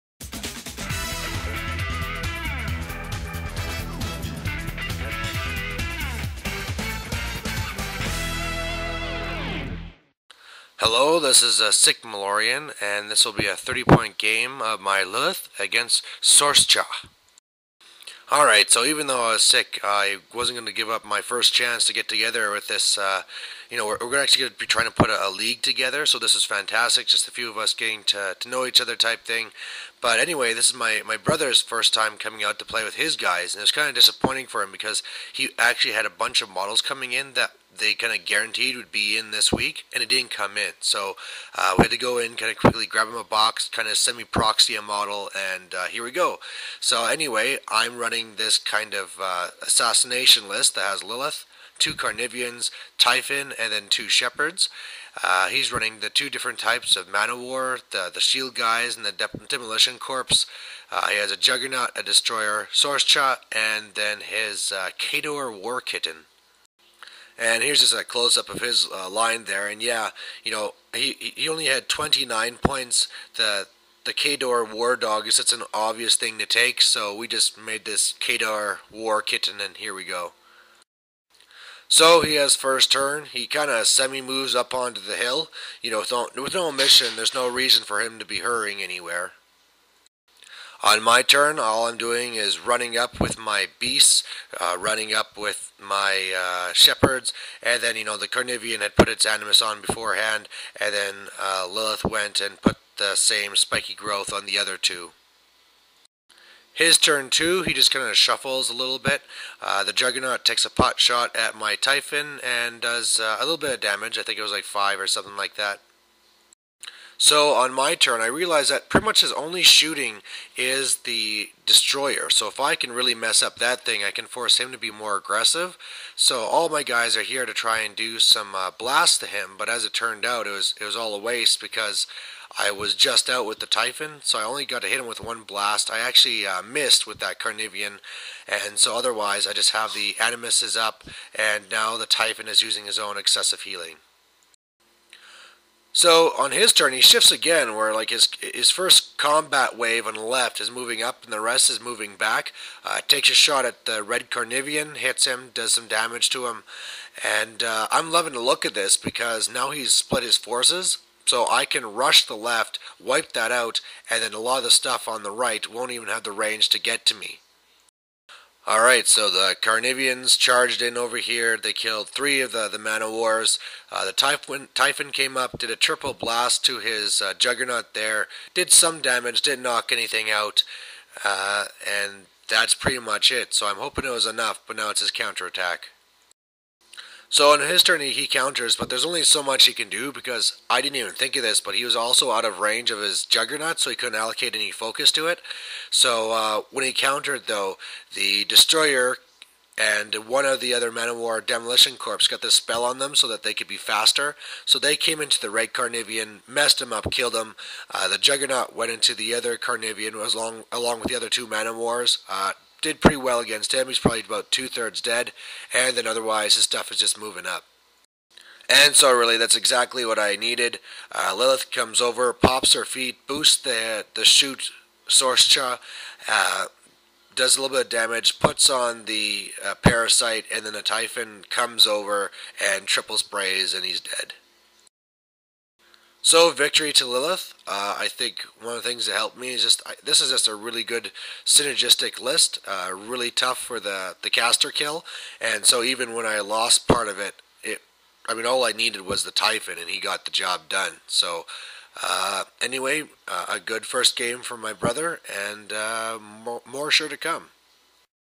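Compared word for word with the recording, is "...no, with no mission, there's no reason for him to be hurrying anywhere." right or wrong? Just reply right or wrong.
right.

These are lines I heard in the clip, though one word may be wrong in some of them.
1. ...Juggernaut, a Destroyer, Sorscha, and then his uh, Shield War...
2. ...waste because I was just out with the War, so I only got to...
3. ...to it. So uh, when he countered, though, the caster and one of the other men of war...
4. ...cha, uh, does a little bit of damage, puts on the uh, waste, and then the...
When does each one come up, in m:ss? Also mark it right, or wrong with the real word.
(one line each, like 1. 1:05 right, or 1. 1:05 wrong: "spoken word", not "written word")
1. 1:01 wrong: "Khador", not "Shield"
2. 2:11 wrong: "Typhon", not "War"
3. 3:15 wrong: "destroyer", not "caster"
4. 3:45 wrong: "parasite", not "waste".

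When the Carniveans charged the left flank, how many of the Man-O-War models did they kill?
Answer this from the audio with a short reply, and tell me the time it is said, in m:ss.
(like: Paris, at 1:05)
3, at 2:52.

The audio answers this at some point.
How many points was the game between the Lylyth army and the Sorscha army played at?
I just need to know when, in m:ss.
0:13.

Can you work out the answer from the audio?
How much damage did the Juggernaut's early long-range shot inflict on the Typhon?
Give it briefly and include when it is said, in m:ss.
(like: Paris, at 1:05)
5, at 1:54.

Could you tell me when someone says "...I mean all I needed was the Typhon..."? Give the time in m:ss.
4:08.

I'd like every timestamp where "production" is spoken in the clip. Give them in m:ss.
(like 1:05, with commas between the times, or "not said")
not said.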